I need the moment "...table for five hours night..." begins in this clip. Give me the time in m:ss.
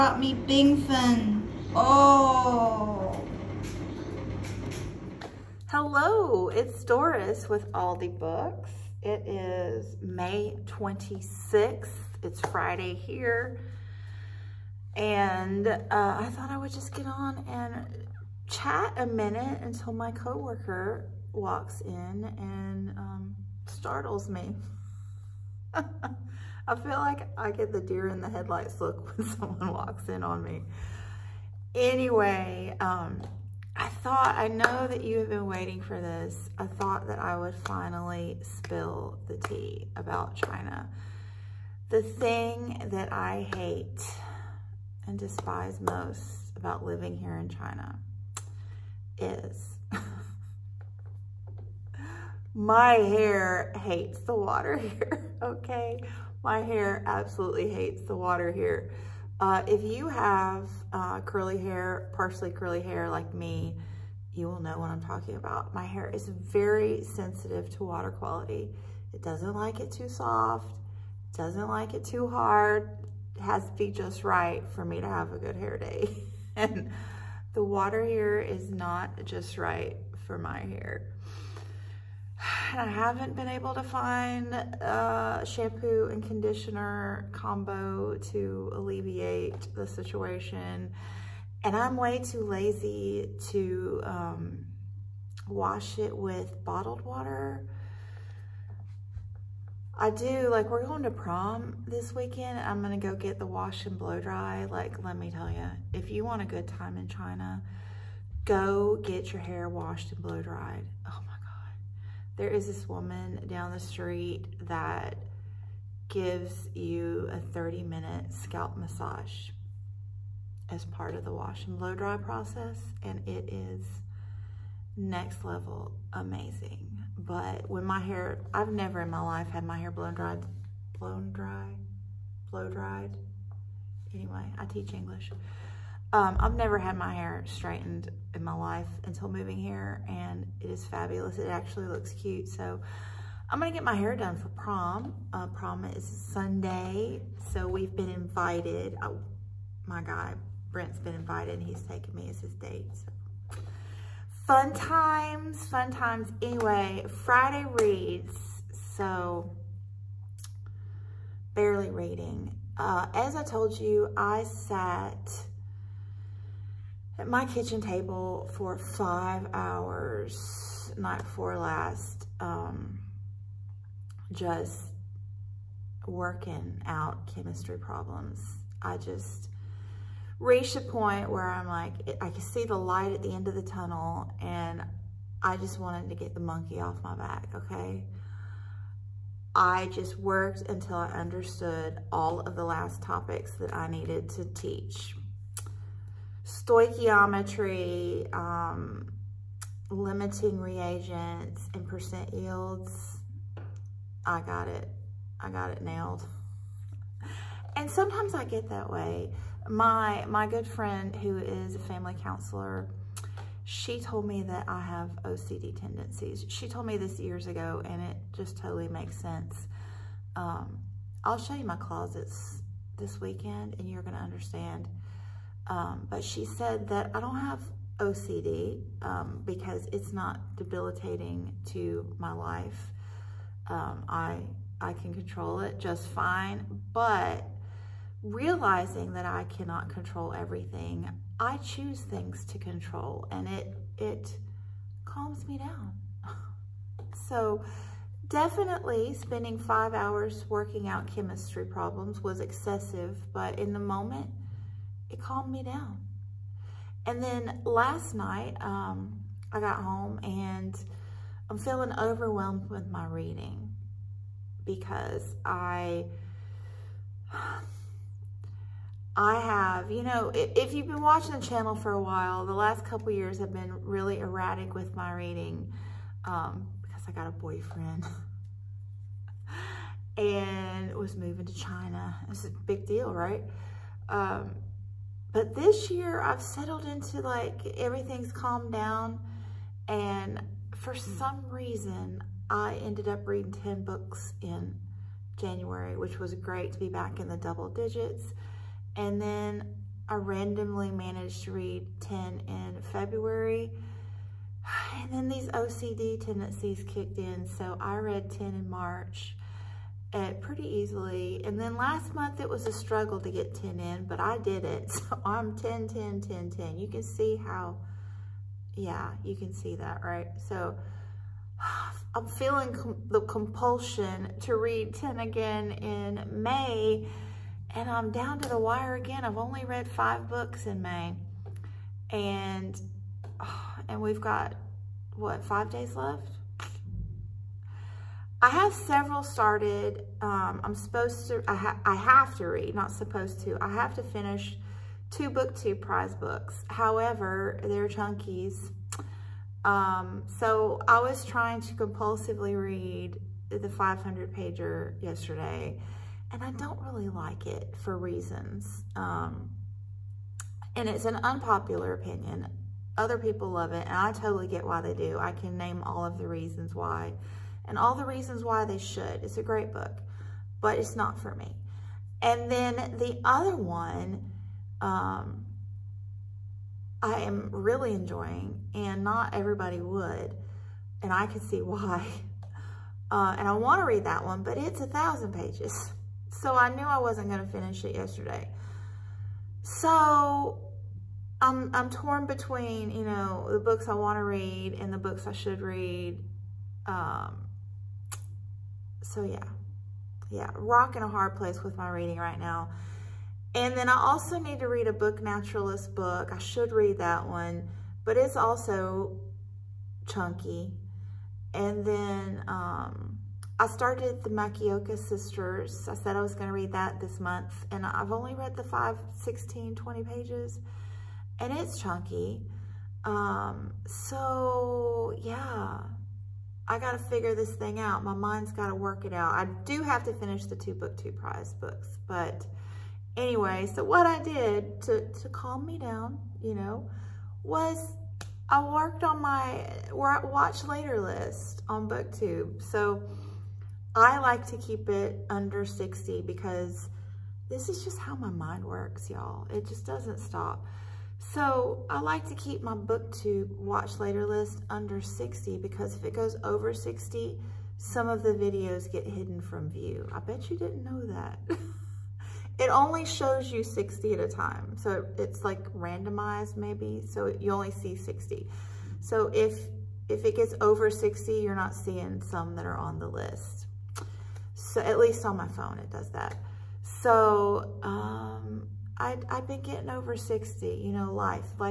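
2:47.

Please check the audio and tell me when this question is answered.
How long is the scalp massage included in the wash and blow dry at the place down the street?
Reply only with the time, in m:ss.
1:57.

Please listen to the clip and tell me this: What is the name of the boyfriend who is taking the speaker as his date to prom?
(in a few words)
Brent.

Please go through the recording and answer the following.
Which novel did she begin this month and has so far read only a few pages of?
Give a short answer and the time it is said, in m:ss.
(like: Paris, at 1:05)
The Makioka Sisters, at 6:54.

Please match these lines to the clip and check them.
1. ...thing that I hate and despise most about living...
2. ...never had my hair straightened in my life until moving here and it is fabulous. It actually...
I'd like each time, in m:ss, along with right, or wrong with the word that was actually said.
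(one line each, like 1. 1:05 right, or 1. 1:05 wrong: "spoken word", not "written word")
1. 0:42 right
2. 2:16 right.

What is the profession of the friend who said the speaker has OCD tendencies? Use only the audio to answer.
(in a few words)
family counselor.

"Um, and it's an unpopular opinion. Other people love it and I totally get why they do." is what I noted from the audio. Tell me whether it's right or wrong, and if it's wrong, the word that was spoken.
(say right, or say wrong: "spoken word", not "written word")
right.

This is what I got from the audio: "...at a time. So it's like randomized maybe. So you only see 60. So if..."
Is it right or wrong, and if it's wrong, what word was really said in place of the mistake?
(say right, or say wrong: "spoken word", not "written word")
right.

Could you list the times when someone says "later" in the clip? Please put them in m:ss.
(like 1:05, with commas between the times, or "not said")
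7:20, 7:33.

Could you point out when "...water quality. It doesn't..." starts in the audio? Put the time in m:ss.
1:07.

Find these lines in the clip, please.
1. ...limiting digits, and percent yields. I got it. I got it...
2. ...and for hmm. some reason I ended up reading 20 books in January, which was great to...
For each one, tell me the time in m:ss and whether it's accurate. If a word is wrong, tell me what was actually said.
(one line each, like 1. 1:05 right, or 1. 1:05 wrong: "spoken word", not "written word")
1. 3:19 wrong: "reagents", not "digits"
2. 4:49 wrong: "10", not "20".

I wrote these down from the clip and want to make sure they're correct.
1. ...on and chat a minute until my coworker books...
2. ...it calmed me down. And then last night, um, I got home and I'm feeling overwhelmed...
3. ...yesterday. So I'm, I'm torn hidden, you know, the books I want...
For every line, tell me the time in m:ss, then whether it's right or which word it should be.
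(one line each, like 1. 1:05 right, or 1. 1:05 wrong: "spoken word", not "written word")
1. 0:17 wrong: "walks", not "books"
2. 4:15 right
3. 6:27 wrong: "between", not "hidden".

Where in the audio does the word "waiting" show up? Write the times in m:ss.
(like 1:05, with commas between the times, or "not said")
0:35.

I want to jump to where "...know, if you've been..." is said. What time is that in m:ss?
4:30.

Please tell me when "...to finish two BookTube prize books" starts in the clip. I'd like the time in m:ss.
5:43.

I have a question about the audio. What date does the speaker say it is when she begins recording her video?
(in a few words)
May 26th.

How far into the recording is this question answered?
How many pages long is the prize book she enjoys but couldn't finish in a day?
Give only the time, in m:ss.
6:24.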